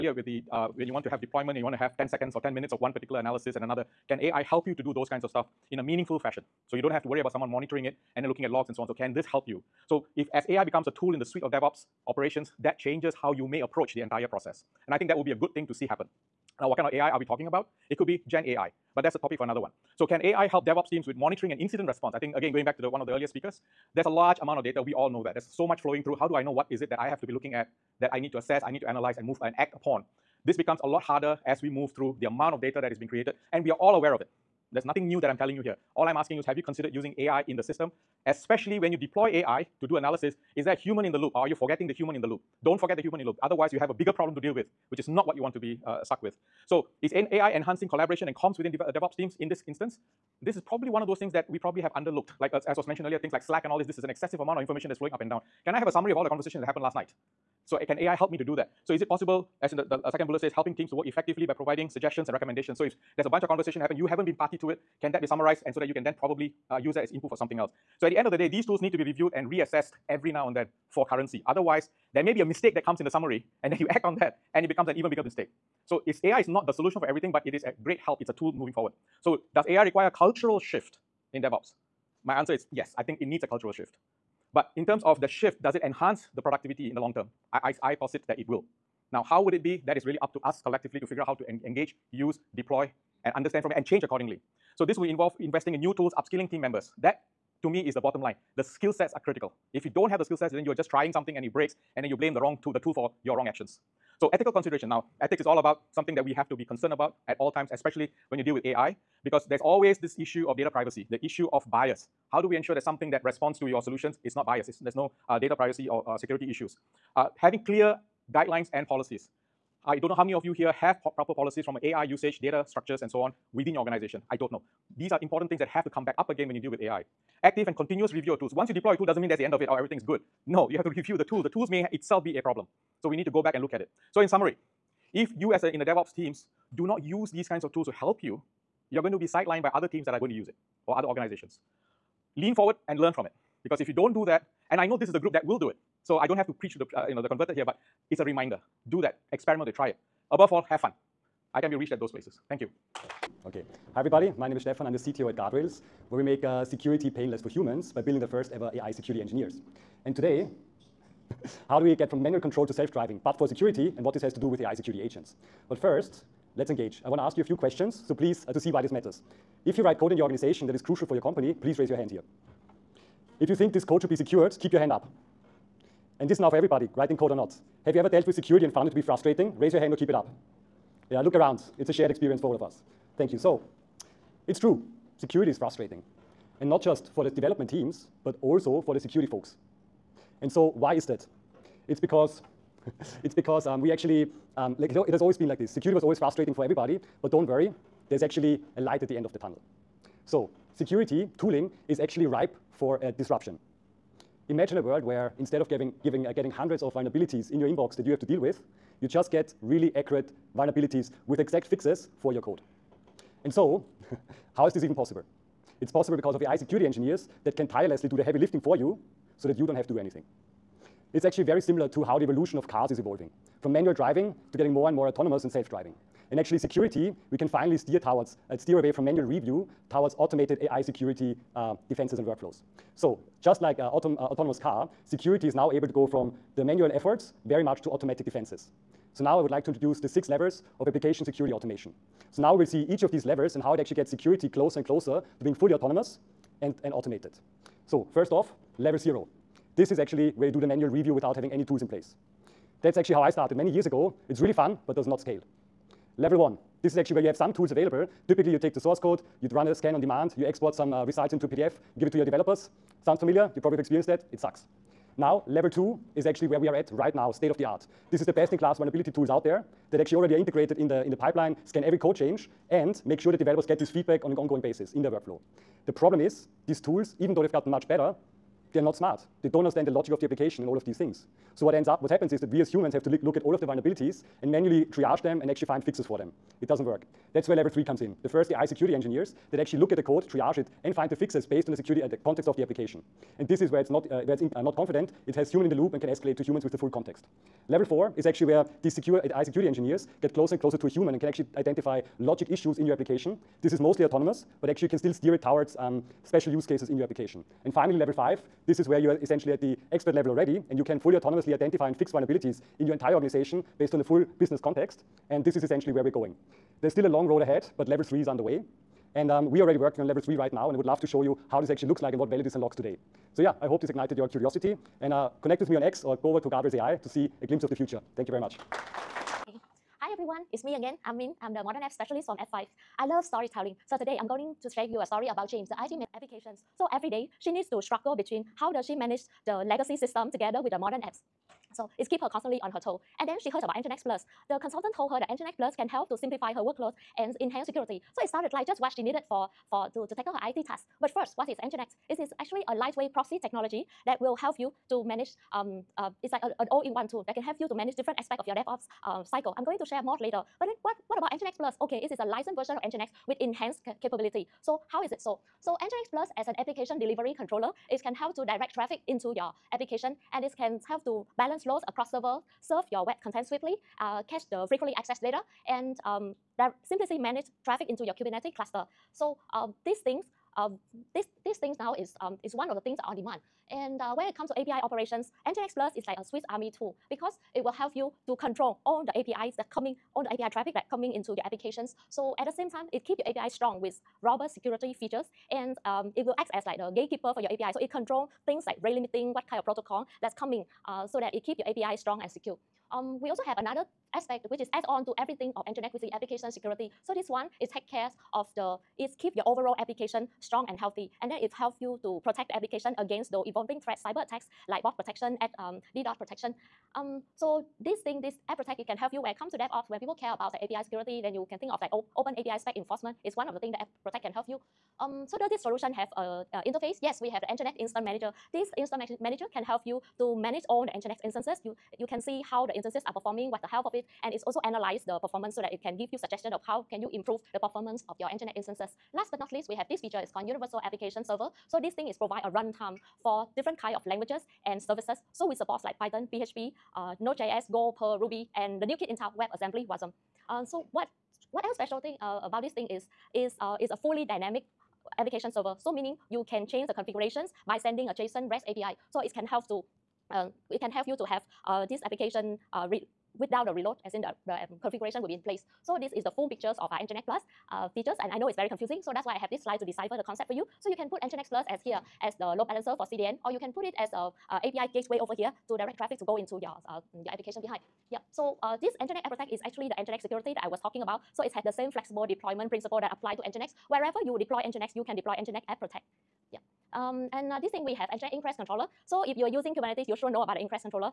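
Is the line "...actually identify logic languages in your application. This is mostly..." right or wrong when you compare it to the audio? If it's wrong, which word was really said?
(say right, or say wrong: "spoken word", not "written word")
wrong: "issues", not "languages".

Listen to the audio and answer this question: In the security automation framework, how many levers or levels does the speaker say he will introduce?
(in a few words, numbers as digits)
6.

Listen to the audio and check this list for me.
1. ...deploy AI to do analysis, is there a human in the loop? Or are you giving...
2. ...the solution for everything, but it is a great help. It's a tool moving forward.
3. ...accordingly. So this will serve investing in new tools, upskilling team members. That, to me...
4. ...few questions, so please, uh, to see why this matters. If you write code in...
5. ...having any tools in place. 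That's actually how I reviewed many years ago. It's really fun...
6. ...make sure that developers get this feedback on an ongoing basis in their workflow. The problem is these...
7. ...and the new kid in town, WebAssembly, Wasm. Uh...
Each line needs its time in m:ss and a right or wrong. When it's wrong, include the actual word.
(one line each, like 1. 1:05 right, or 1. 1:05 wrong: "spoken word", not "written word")
1. 0:38 wrong: "forgetting", not "giving"
2. 1:16 right
3. 1:34 wrong: "involve", not "serve"
4. 2:47 right
5. 4:11 wrong: "started", not "reviewed"
6. 4:33 right
7. 7:28 right.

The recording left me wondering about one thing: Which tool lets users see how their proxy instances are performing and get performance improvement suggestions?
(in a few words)
Nginx Instance Manager.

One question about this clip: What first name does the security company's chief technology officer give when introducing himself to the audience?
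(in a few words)
Stefan.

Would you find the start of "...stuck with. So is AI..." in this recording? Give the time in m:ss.
0:46.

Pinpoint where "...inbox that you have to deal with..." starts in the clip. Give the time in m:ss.
3:27.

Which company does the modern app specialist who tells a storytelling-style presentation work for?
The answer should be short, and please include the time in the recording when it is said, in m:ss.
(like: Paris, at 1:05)
F5, at 5:32.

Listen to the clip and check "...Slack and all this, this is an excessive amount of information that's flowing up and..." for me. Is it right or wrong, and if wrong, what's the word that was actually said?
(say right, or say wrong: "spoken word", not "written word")
right.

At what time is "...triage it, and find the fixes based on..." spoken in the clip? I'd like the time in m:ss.
4:50.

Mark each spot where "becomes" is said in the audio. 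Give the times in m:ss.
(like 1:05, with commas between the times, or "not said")
0:10, 0:30, 1:14.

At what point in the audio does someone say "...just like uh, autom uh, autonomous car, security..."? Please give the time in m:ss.
3:53.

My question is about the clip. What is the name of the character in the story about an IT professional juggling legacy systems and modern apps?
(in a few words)
James.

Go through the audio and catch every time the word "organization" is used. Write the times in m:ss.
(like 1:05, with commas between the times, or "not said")
2:03, 2:21, 2:50, 5:13.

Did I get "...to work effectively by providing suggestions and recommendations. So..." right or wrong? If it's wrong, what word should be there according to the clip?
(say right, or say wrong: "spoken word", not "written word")
right.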